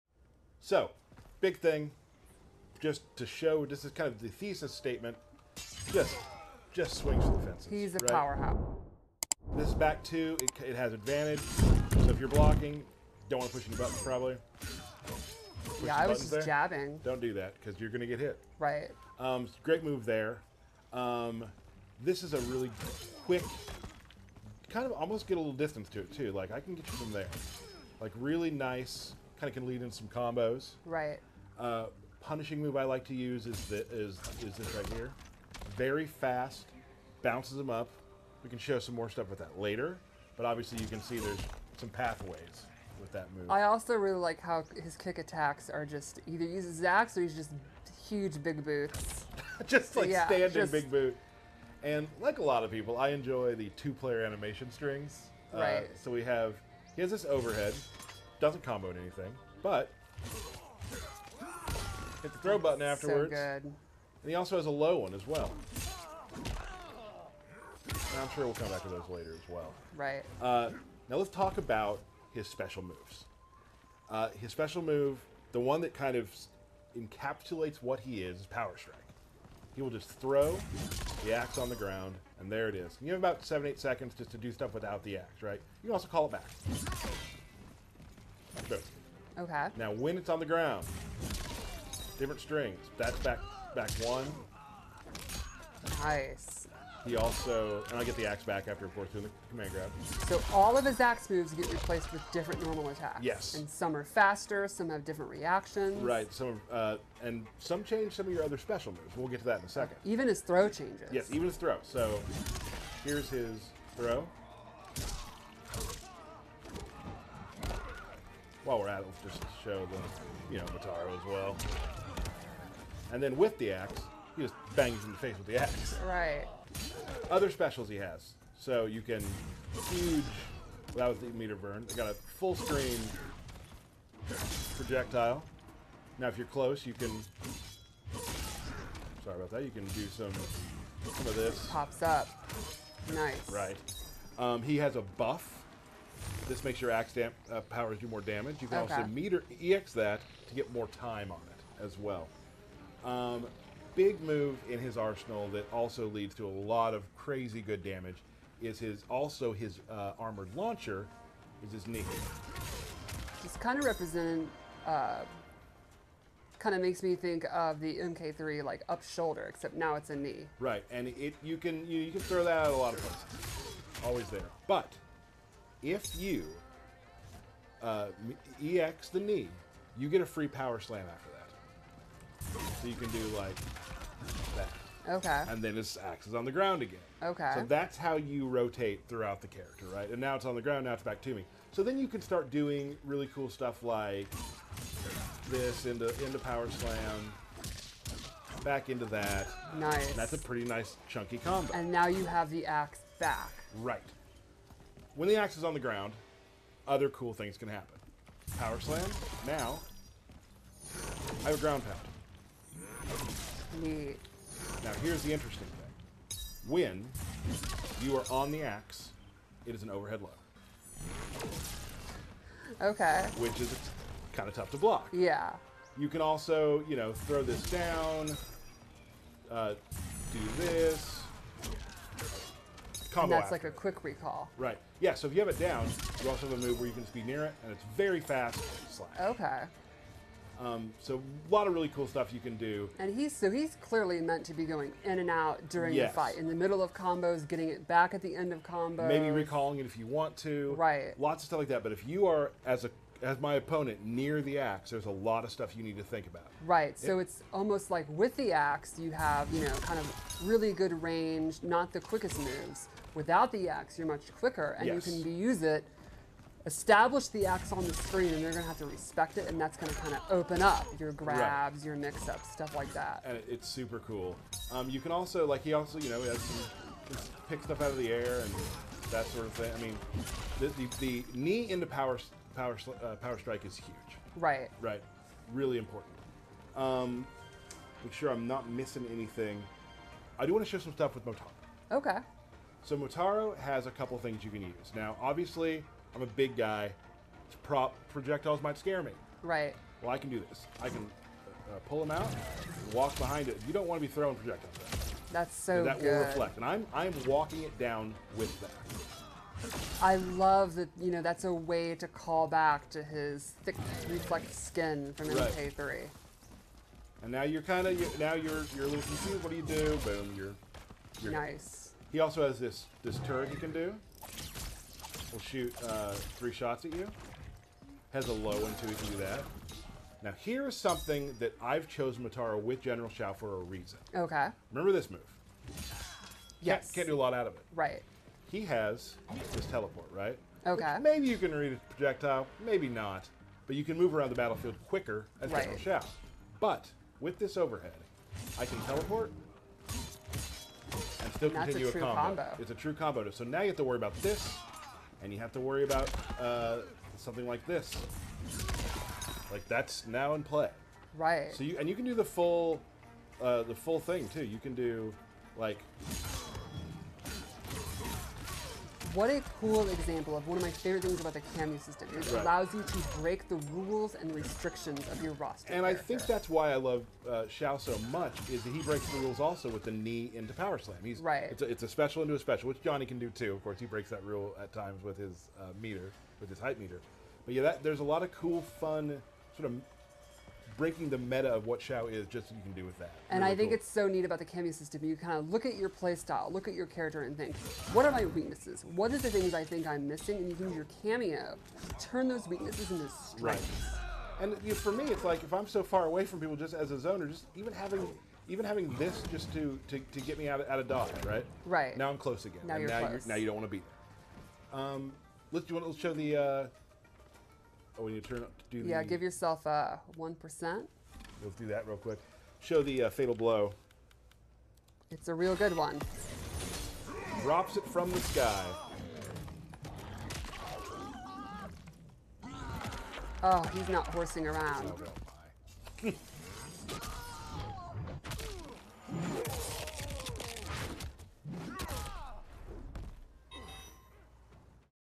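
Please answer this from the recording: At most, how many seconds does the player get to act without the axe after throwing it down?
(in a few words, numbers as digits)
8.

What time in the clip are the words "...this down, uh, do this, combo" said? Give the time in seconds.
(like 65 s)
227 s.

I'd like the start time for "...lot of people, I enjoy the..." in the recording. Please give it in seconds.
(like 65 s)
52 s.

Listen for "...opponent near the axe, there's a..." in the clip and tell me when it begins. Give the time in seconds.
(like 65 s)
253 s.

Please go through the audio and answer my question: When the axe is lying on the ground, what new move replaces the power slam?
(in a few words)
Ground pound.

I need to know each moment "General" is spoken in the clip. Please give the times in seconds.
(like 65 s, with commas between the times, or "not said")
332 s, 345 s.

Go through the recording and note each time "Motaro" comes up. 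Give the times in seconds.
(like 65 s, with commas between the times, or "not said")
120 s, 292 s, 332 s.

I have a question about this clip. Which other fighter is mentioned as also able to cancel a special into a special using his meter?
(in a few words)
Johnny.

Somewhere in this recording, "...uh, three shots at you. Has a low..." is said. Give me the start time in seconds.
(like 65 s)
325 s.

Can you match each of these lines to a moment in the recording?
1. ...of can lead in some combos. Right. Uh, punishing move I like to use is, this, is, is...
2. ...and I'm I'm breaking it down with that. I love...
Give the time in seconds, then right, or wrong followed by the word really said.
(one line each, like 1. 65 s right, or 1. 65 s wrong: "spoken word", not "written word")
1. 29 s right
2. 306 s wrong: "walking", not "breaking".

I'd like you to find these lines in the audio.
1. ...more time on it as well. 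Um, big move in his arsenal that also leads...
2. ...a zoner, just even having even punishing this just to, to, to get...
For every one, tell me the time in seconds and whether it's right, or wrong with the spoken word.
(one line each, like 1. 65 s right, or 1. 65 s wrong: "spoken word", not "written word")
1. 150 s right
2. 406 s wrong: "having", not "punishing".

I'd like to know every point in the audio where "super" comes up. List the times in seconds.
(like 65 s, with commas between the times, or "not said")
273 s.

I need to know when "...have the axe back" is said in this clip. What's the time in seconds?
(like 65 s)
202 s.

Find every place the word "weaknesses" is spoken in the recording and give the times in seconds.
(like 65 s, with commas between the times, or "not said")
398 s, 402 s.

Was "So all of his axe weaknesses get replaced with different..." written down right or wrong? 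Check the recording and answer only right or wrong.
wrong.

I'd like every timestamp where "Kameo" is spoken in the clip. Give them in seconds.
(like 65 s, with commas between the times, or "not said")
371 s, 394 s, 401 s.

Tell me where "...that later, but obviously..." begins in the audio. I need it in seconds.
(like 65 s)
39 s.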